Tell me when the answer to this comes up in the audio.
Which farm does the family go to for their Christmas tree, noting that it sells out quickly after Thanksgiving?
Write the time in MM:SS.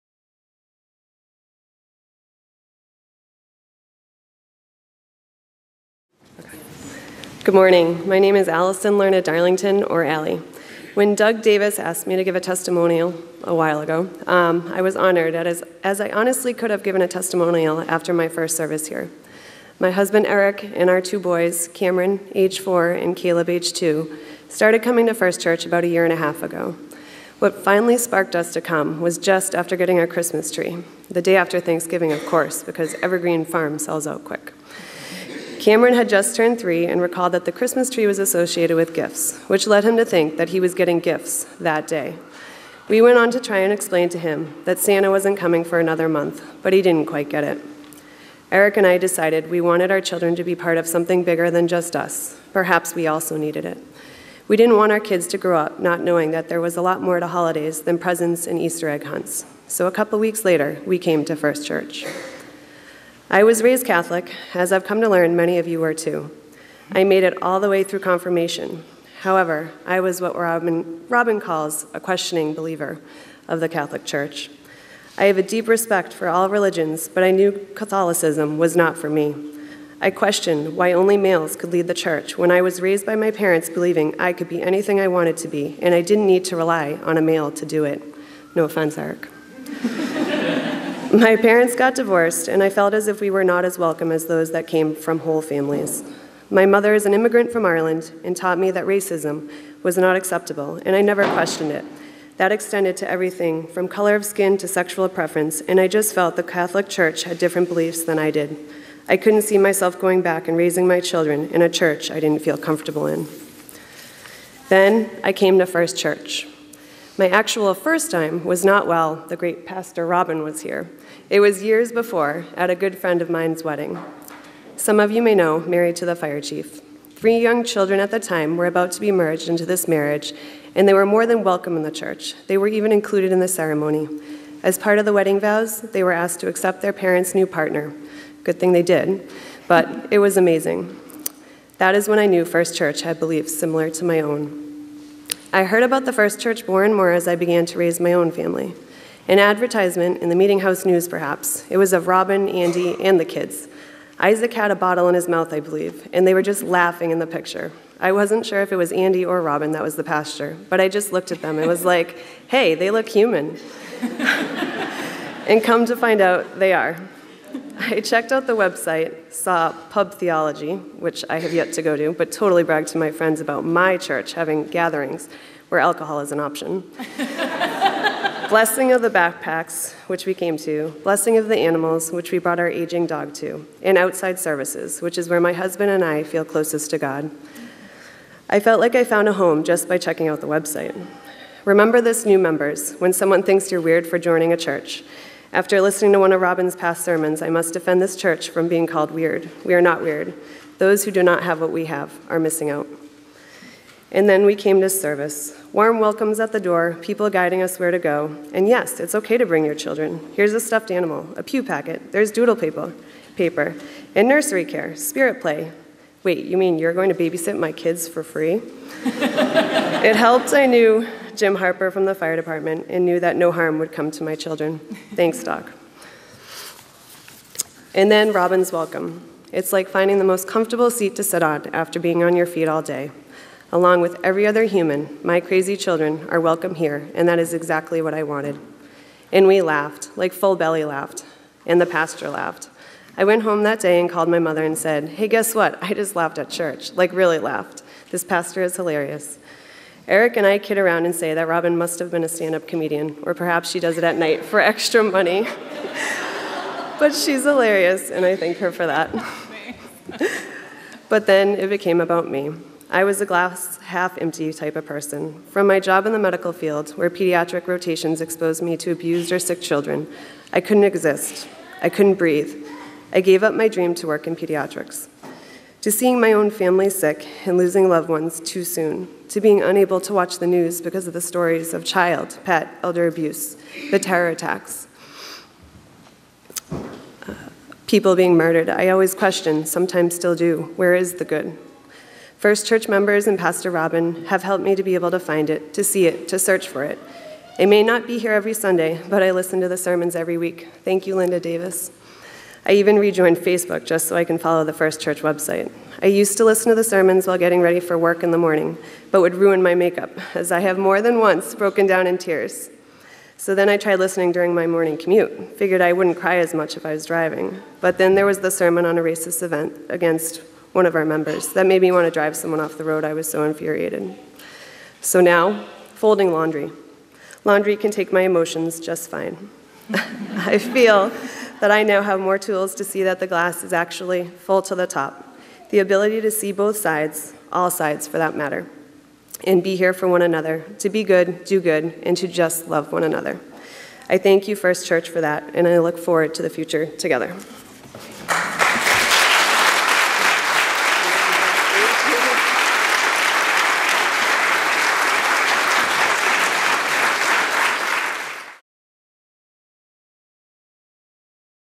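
00:33.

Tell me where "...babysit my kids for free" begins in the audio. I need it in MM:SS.
03:37.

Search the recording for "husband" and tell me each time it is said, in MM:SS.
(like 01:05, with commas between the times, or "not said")
00:19, 03:05.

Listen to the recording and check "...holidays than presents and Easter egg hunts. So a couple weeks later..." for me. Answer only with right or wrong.
right.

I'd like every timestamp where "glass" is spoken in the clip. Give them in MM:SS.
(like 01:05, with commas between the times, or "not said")
04:23, 05:33.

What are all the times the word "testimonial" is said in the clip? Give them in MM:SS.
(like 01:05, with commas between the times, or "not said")
00:12, 00:17.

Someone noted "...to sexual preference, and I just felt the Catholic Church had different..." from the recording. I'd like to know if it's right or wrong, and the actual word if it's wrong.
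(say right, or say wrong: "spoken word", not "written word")
right.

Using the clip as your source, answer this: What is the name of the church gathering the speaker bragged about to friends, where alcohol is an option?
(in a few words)
Pub Theology.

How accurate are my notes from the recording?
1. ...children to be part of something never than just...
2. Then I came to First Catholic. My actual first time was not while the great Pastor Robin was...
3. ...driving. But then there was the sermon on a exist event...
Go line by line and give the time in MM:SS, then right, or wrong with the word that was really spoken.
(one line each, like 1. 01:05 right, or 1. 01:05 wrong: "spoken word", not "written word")
1. 00:50 wrong: "bigger", not "never"
2. 01:54 wrong: "Church", not "Catholic"
3. 05:17 wrong: "racist", not "exist".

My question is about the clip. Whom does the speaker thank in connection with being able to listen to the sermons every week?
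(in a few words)
Linda Davis.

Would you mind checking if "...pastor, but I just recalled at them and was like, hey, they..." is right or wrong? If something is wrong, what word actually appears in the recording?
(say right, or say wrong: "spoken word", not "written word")
wrong: "looked", not "recalled".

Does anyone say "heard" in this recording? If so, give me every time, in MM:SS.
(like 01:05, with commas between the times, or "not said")
02:25.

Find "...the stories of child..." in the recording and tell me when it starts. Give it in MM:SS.
04:41.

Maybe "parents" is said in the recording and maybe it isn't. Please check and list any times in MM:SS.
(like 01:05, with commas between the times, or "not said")
01:23, 01:31, 02:16.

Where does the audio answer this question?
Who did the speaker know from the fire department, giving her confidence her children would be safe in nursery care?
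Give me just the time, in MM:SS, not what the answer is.
03:41.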